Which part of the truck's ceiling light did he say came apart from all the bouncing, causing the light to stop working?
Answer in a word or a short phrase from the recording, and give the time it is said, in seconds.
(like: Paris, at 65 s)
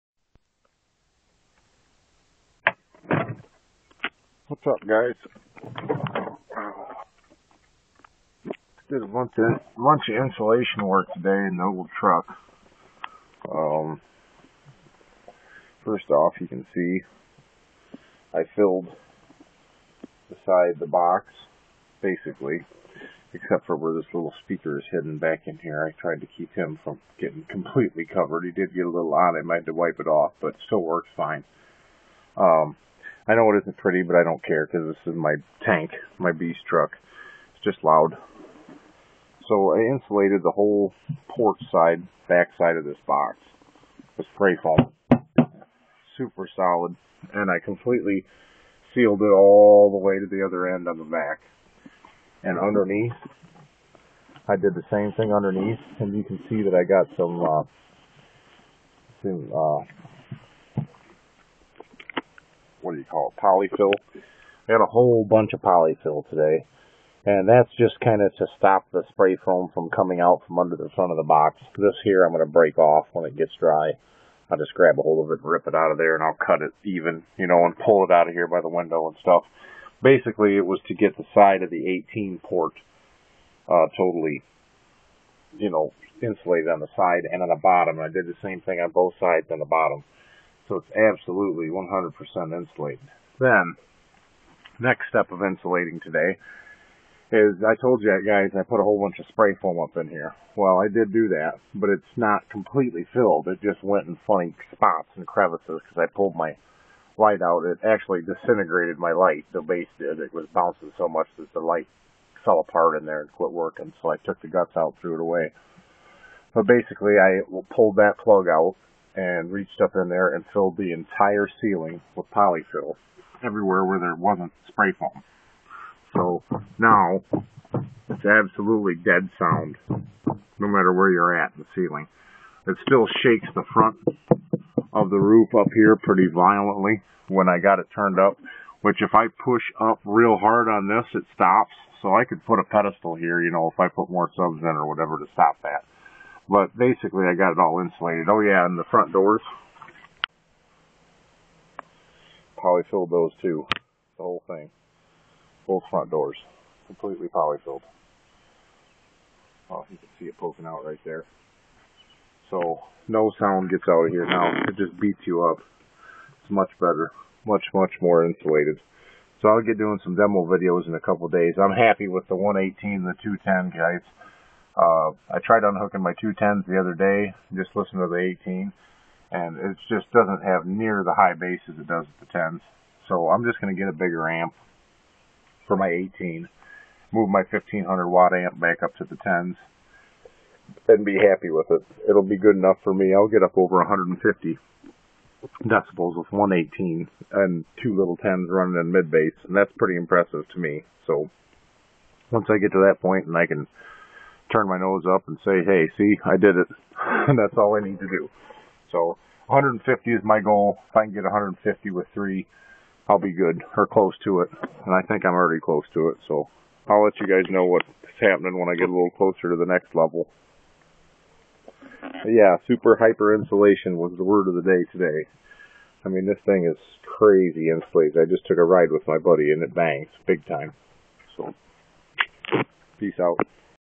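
The base, at 109 s.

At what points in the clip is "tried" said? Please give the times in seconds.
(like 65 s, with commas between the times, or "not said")
25 s, 175 s.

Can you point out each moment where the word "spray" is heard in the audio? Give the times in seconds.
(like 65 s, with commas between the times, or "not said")
44 s, 69 s, 99 s, 124 s.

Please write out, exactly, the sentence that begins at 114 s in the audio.
So I took the guts out, threw it away.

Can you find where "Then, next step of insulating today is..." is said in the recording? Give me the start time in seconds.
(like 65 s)
93 s.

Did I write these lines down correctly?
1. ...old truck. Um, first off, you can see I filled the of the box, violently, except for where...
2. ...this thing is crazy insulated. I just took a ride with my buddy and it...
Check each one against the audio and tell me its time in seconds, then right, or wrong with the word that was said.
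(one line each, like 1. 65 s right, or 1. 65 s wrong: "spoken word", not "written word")
1. 11 s wrong: "basically", not "violently"
2. 226 s right.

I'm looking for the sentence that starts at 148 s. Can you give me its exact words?
Oh yeah, and the front doors.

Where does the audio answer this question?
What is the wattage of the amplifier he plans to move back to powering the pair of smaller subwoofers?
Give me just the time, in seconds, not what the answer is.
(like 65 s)
187 s.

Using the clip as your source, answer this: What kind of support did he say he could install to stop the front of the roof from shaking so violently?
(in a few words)
A pedestal.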